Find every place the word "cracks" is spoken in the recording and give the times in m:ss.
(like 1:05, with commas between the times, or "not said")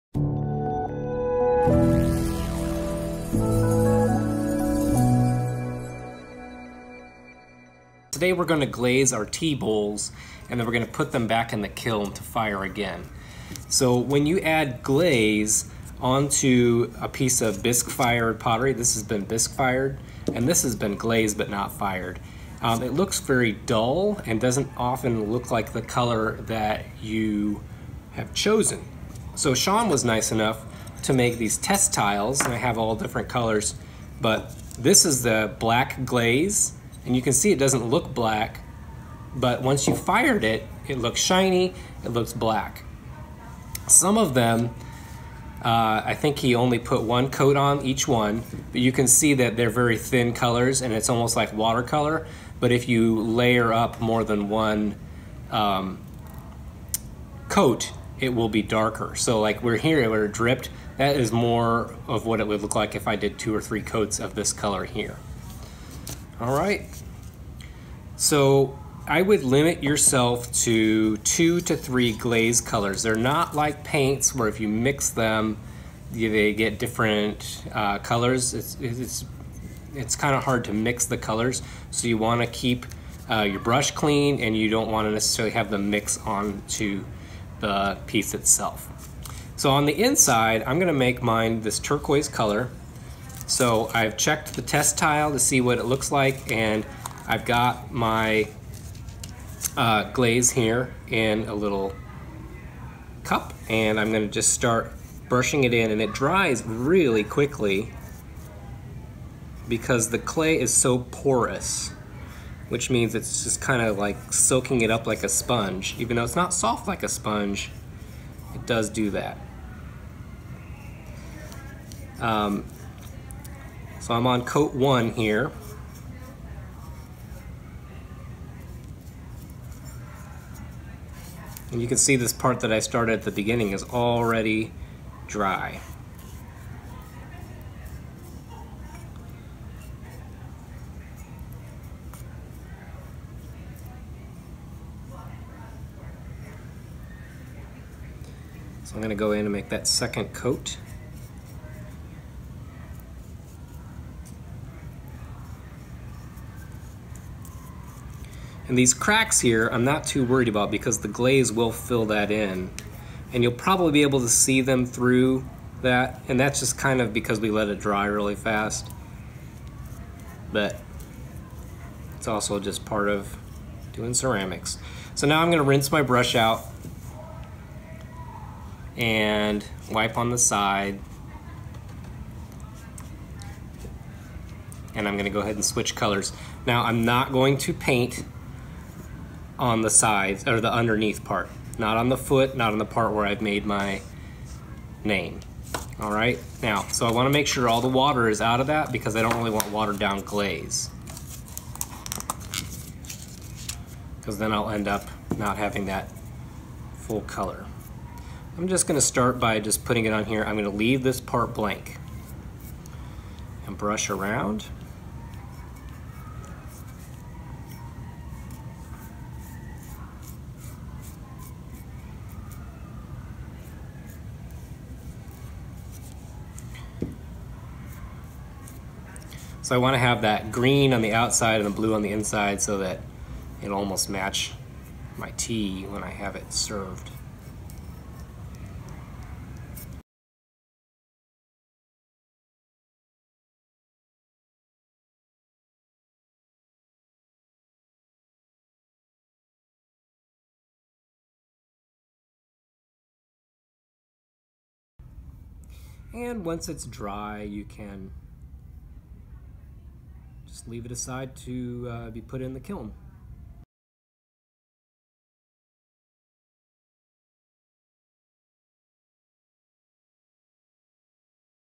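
2:38.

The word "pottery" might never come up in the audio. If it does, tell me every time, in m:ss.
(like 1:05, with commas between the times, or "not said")
0:18.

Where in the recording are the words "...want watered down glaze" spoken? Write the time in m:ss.
3:19.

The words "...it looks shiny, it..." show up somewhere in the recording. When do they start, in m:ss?
0:40.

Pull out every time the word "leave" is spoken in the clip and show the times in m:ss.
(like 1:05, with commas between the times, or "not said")
3:30, 4:20.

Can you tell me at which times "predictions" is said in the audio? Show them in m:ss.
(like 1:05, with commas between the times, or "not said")
not said.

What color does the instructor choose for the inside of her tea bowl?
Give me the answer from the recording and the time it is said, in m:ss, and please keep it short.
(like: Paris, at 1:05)
Turquoise, at 1:31.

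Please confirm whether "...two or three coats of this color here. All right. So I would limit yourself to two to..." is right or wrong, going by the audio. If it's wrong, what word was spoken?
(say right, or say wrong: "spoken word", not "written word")
right.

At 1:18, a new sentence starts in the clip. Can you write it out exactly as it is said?
It's, it's, it's kind of hard to mix the colors.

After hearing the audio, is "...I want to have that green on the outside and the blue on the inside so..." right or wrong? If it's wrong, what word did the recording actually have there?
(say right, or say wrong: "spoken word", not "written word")
right.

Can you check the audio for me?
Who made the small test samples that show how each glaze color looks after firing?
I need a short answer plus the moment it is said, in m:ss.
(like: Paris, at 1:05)
Sean, at 0:29.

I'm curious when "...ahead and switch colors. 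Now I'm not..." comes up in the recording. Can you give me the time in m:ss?
3:05.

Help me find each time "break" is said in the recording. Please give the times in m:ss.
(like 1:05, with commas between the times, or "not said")
not said.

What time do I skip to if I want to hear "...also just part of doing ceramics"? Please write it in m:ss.
2:52.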